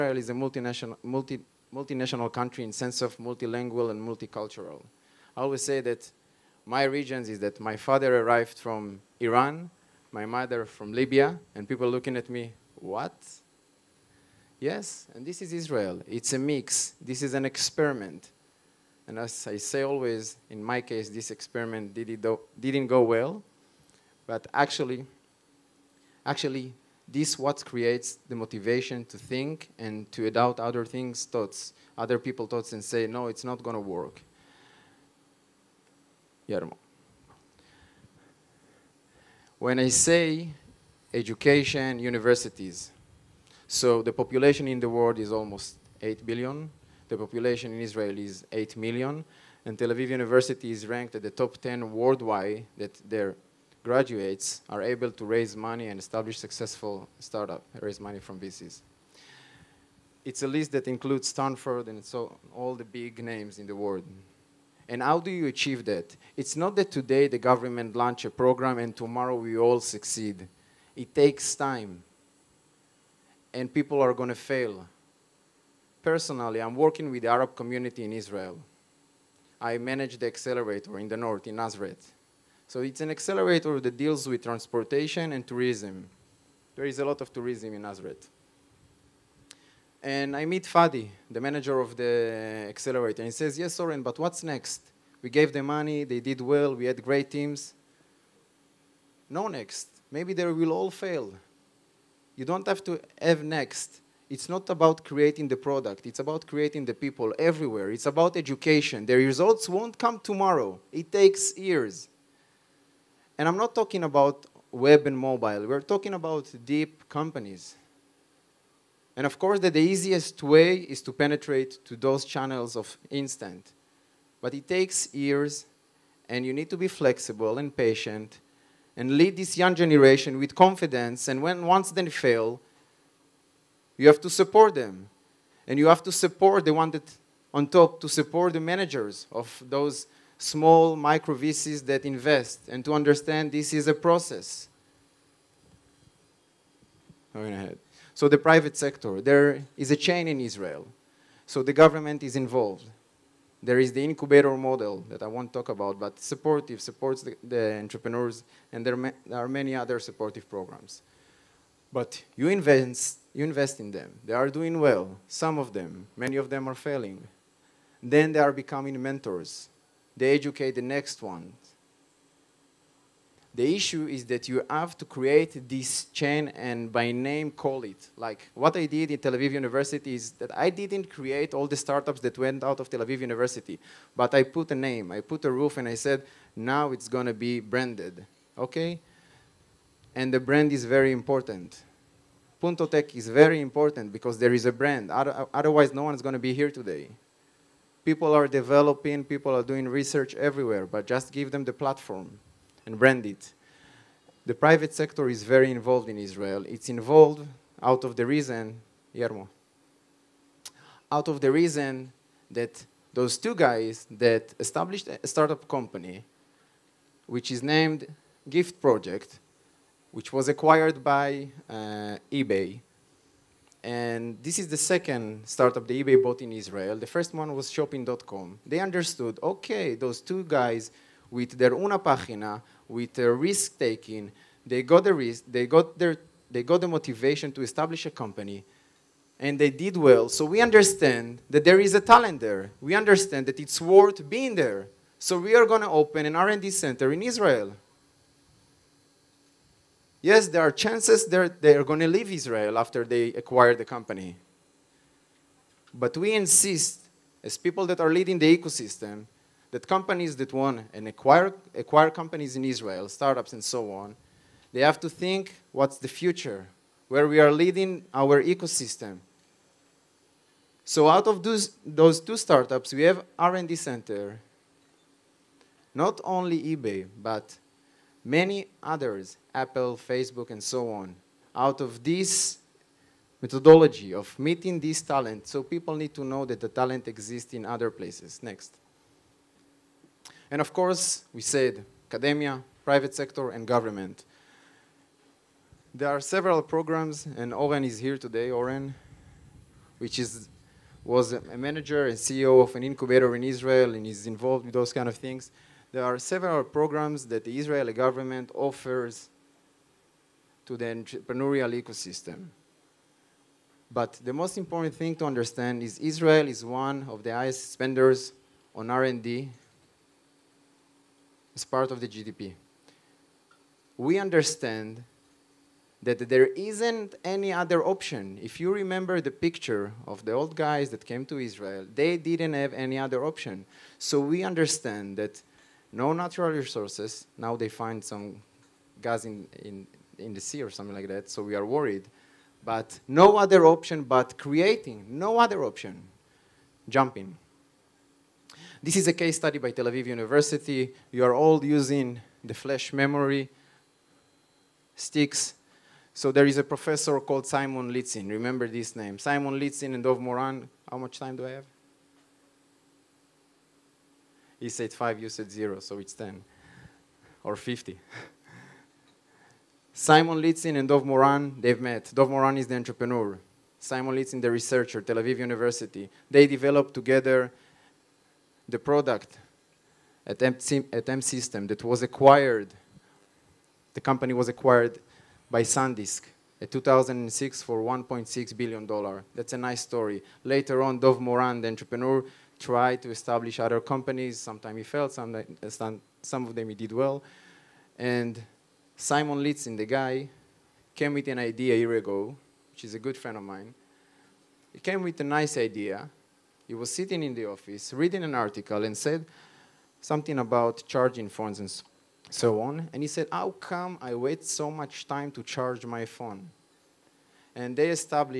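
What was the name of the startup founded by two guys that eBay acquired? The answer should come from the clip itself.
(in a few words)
Gift Project.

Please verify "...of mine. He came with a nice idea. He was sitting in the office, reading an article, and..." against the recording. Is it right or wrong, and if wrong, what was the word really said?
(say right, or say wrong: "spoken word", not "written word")
right.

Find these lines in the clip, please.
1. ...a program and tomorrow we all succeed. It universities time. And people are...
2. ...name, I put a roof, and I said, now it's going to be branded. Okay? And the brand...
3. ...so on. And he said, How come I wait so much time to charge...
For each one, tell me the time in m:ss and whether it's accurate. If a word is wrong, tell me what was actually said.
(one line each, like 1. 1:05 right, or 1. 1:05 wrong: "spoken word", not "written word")
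1. 1:08 wrong: "takes", not "universities"
2. 3:04 right
3. 6:52 right.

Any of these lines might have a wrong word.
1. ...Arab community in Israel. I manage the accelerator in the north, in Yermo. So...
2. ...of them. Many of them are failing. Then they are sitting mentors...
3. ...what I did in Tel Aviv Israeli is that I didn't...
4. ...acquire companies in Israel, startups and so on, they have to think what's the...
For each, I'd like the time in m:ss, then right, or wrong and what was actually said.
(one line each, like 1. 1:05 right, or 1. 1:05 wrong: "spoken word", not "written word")
1. 1:17 wrong: "Nazareth", not "Yermo"
2. 2:45 wrong: "becoming", not "sitting"
3. 2:58 wrong: "University", not "Israeli"
4. 4:21 right.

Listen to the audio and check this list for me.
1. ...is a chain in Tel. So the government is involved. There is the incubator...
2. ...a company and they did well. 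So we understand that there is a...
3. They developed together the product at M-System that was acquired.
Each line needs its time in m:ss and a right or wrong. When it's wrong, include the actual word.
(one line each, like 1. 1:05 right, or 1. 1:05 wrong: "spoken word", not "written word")
1. 2:29 wrong: "Israel", not "Tel"
2. 3:58 right
3. 6:16 right.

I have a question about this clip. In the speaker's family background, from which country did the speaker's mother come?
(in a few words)
Libya.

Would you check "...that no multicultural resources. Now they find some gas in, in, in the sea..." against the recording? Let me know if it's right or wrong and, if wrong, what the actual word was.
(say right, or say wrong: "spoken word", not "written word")
wrong: "natural", not "multicultural".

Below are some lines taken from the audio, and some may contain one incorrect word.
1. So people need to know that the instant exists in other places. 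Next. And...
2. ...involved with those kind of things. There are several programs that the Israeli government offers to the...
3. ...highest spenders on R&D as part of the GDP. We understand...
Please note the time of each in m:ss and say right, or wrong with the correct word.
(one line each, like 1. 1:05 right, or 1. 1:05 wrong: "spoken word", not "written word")
1. 4:45 wrong: "talent", not "instant"
2. 5:04 right
3. 5:17 right.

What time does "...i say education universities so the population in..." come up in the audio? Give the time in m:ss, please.
0:39.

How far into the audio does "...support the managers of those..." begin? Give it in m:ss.
2:18.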